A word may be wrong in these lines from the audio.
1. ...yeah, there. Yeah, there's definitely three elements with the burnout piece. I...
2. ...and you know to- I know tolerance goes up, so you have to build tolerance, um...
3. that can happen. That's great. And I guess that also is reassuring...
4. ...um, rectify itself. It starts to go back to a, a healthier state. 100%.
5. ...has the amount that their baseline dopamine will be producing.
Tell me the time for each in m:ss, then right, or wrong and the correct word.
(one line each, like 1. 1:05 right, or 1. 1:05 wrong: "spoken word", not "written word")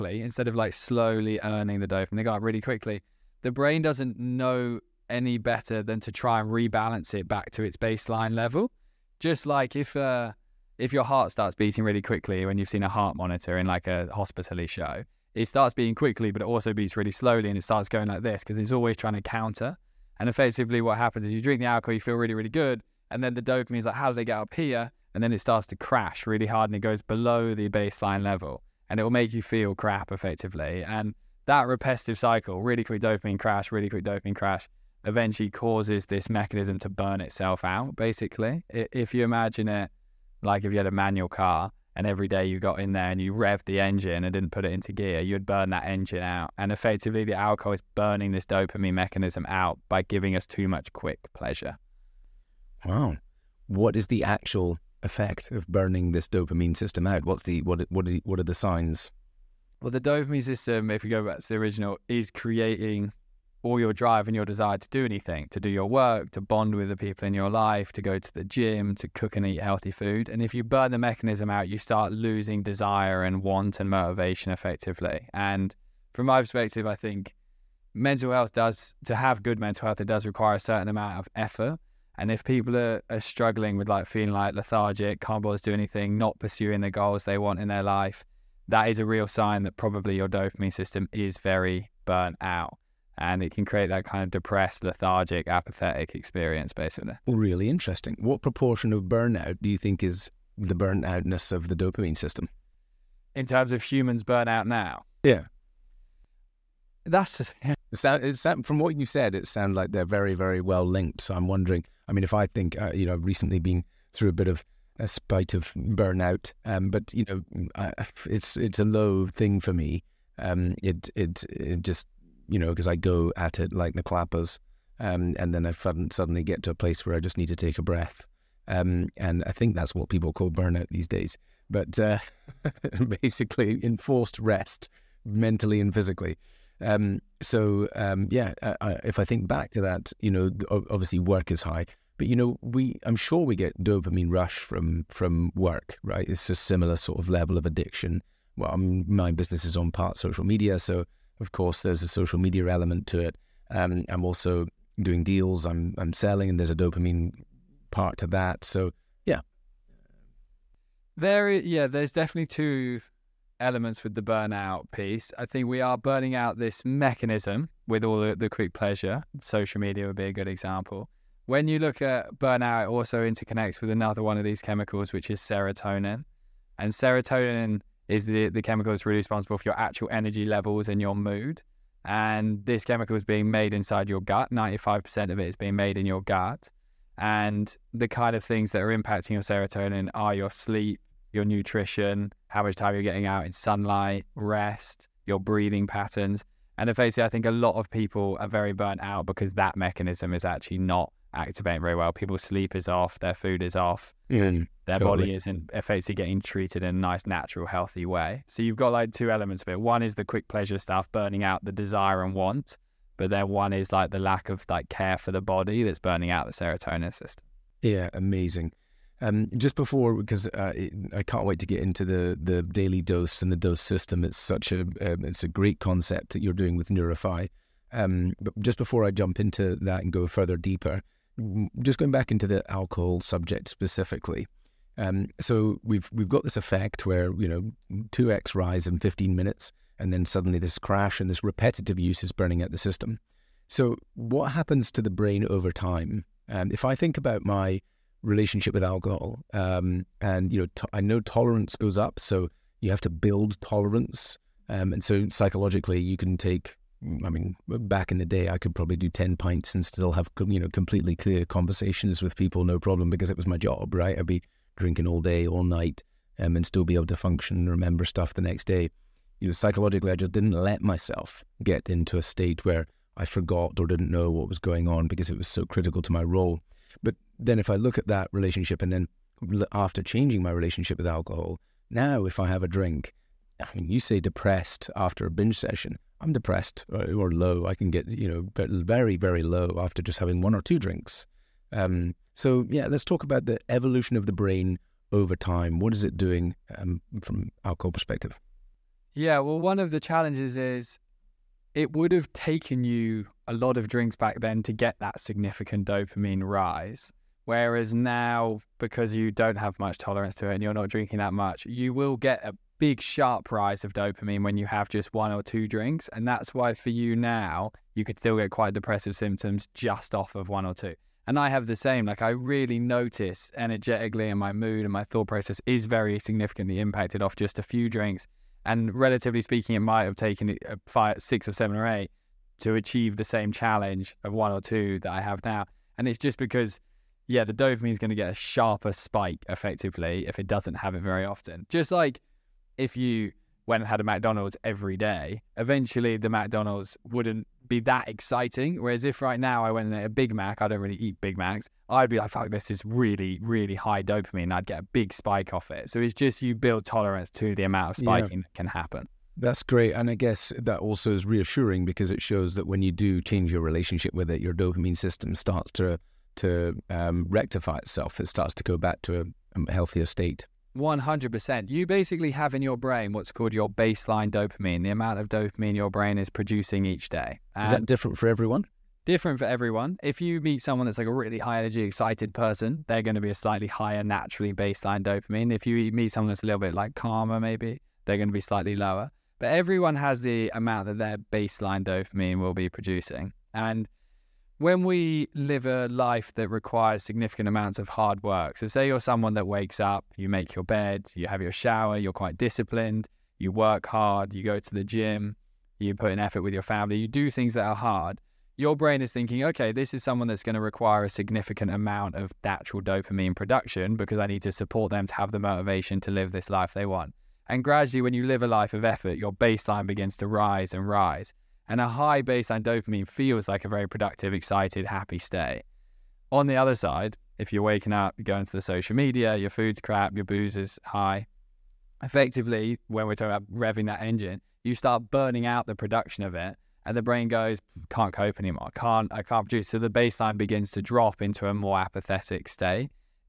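1. 2:39 wrong: "two", not "three"
2. 4:10 right
3. 5:58 right
4. 6:06 right
5. 6:29 right.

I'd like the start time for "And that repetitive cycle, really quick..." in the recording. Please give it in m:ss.
0:30.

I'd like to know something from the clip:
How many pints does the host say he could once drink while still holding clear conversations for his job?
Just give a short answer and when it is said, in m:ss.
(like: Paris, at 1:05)
10, at 4:19.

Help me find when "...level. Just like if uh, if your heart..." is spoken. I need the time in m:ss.
0:08.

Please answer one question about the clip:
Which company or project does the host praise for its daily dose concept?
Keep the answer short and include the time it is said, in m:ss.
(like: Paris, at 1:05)
Neurify, at 3:46.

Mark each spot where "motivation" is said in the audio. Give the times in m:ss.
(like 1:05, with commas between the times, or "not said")
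1:13, 6:55.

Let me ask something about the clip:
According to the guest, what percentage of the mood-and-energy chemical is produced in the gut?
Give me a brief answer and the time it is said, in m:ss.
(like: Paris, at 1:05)
95%, at 3:04.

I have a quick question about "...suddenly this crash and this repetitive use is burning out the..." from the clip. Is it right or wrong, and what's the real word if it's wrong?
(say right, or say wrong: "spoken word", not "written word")
right.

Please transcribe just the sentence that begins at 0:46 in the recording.
And effectively, the alcohol is burning this dopamine mechanism out by giving us too much quick pleasure.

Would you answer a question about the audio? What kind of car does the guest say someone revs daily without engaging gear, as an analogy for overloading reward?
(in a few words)
manual car.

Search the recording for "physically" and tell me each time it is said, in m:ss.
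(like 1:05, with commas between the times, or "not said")
2:15.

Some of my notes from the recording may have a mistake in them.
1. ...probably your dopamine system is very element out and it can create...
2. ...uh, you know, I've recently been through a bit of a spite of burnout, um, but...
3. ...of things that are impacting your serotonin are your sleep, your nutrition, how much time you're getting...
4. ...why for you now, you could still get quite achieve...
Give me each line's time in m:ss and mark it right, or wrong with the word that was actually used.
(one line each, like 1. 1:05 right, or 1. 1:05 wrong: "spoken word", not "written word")
1. 1:29 wrong: "burnt", not "element"
2. 1:52 right
3. 3:08 right
4. 5:16 wrong: "depressive", not "achieve".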